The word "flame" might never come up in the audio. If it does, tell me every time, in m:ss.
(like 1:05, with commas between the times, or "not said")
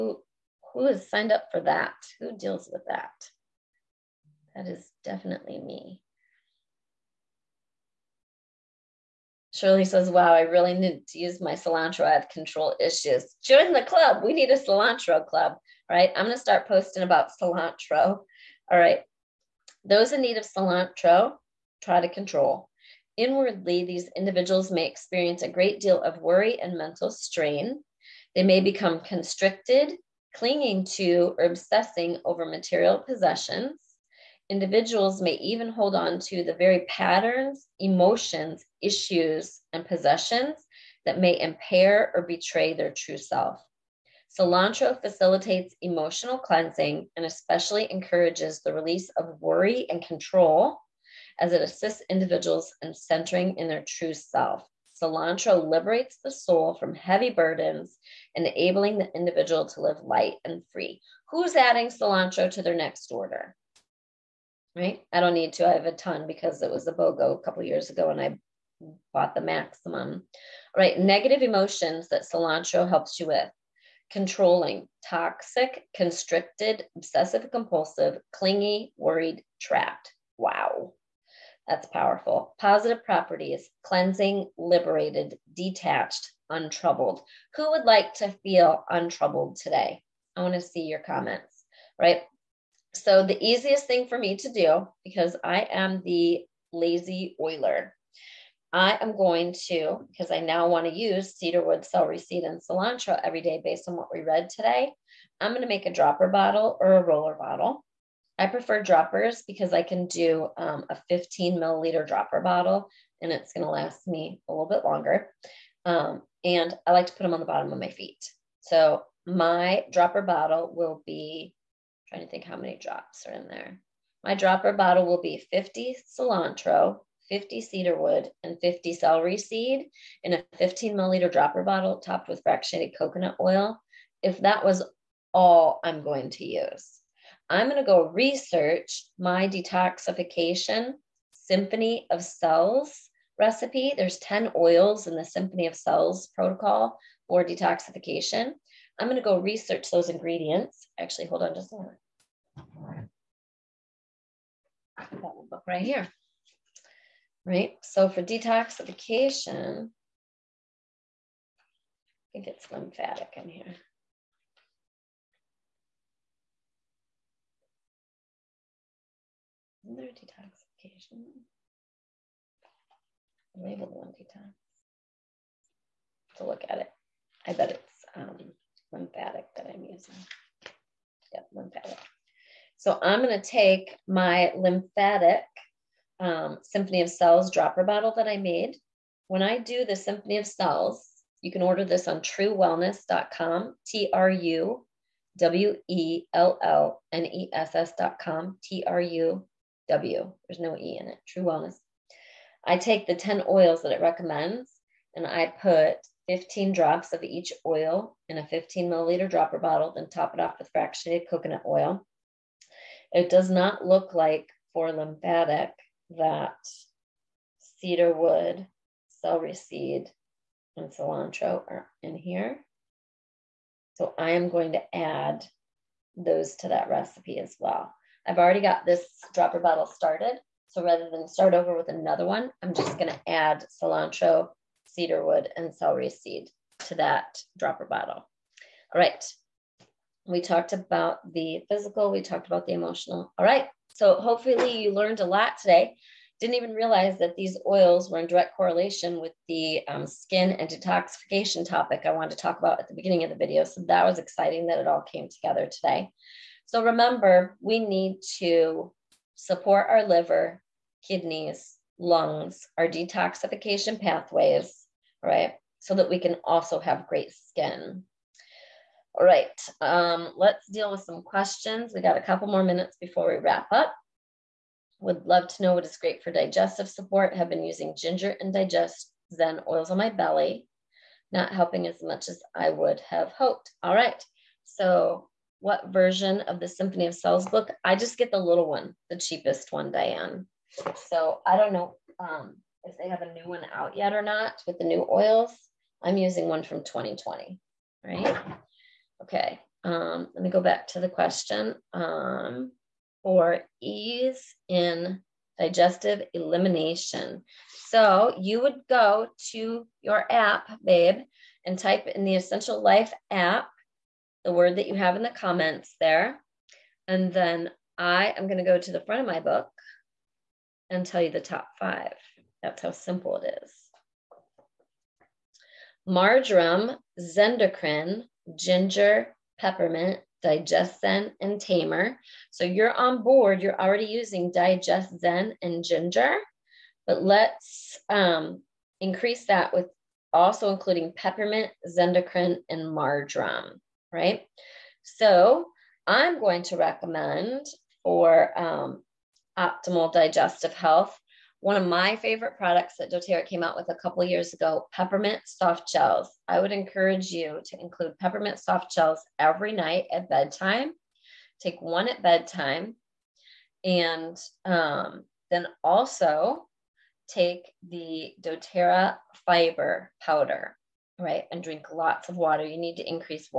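not said.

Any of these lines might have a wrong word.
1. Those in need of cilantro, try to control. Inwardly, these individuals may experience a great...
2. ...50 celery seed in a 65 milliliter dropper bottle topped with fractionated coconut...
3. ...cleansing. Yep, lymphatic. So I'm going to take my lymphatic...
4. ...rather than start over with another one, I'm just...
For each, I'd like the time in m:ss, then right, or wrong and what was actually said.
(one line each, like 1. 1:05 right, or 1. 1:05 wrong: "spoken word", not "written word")
1. 0:19 right
2. 2:08 wrong: "15", not "65"
3. 2:59 wrong: "using", not "cleansing"
4. 3:50 right.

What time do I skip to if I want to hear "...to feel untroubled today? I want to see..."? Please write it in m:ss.
1:28.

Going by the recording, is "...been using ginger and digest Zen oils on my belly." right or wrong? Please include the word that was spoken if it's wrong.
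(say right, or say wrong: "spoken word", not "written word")
right.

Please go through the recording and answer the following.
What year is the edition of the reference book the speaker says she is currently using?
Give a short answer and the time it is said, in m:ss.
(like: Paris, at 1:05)
2020, at 4:56.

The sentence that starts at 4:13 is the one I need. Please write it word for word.
So that was exciting that it all came together today.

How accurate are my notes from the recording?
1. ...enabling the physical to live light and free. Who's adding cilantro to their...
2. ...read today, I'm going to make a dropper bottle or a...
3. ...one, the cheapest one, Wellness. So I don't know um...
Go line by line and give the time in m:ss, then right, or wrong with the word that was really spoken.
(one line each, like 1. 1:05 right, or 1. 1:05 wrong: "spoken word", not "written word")
1. 0:58 wrong: "individual", not "physical"
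2. 1:44 right
3. 4:48 wrong: "Diane", not "Wellness".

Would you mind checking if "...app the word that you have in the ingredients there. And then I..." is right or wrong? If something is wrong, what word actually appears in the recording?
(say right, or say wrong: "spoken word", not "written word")
wrong: "comments", not "ingredients".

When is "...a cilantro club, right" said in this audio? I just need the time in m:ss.
0:14.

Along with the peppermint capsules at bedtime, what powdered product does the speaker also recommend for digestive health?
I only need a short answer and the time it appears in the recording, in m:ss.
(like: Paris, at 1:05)
doTERRA fiber powder, at 6:09.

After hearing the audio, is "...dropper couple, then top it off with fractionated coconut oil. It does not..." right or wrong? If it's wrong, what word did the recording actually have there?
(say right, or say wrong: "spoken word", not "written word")
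wrong: "bottle", not "couple".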